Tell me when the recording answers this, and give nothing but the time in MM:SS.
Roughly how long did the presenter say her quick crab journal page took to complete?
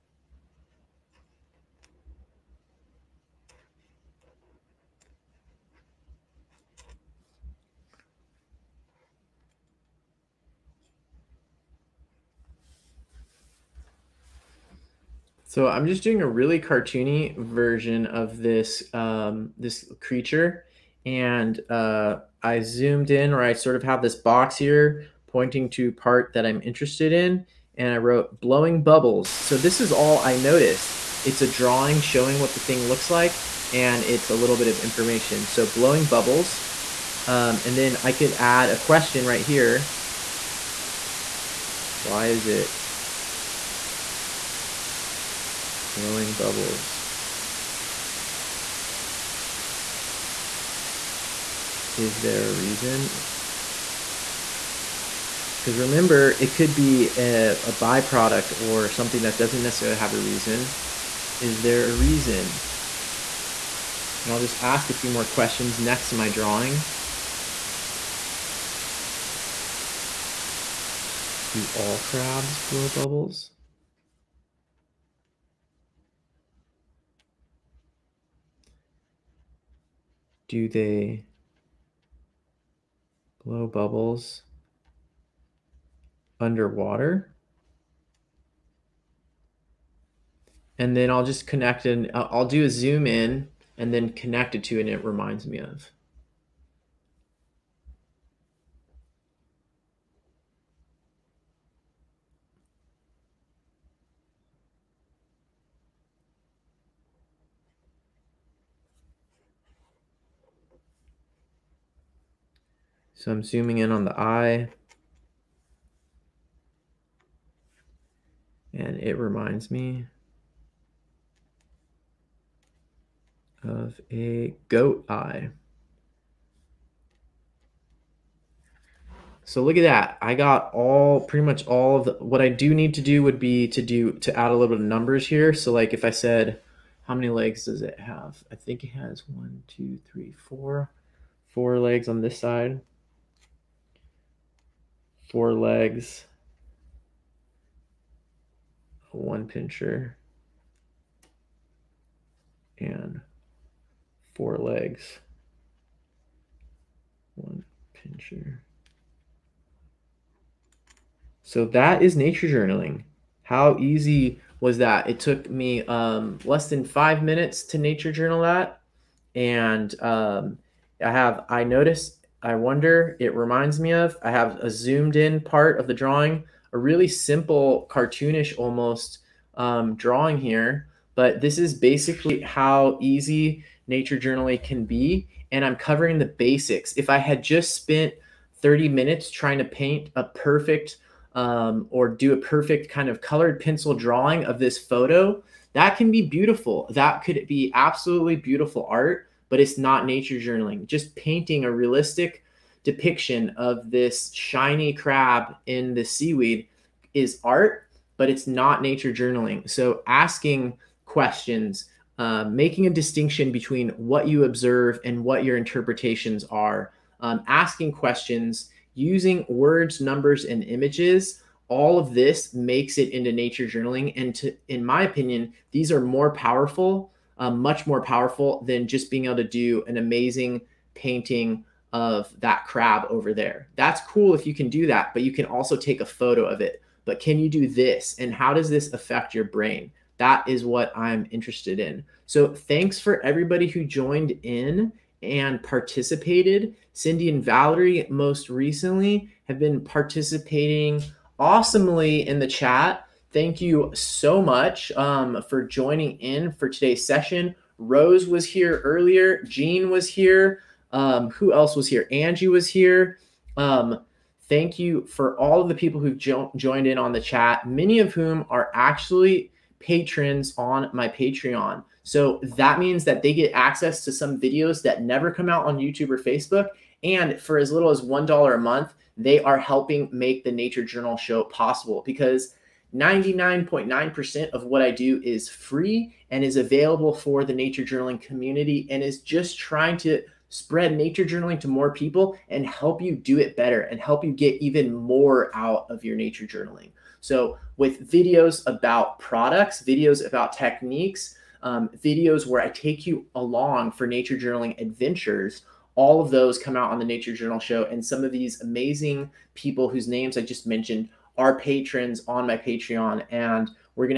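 02:46.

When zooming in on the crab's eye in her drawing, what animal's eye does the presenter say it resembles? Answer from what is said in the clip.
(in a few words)
goat.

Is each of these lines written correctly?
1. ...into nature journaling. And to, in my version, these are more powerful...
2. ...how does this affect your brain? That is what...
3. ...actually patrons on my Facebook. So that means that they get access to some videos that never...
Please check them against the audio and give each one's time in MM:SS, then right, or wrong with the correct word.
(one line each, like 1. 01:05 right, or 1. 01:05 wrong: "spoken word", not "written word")
1. 03:43 wrong: "opinion", not "version"
2. 03:58 right
3. 04:28 wrong: "Patreon", not "Facebook".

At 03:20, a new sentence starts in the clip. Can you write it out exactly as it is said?
Just painting a realistic depiction of this shiny crab in the seaweed is art, but it's not nature journaling.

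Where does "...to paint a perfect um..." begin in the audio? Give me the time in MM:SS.
03:09.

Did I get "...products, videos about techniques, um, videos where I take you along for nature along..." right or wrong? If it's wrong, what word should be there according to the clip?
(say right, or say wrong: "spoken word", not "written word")
wrong: "journaling", not "along".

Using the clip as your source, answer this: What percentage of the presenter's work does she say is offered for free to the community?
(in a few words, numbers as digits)
99.9%.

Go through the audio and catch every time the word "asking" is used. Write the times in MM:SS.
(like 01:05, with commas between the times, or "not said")
03:30, 03:37.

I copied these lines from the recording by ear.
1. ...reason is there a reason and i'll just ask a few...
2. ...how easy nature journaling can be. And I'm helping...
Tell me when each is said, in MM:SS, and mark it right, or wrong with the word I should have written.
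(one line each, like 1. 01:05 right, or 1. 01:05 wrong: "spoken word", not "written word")
1. 01:00 right
2. 03:02 wrong: "covering", not "helping".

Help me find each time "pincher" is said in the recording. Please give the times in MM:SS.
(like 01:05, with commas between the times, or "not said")
02:29, 02:37.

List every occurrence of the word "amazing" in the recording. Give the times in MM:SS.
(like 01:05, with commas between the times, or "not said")
03:49, 05:08.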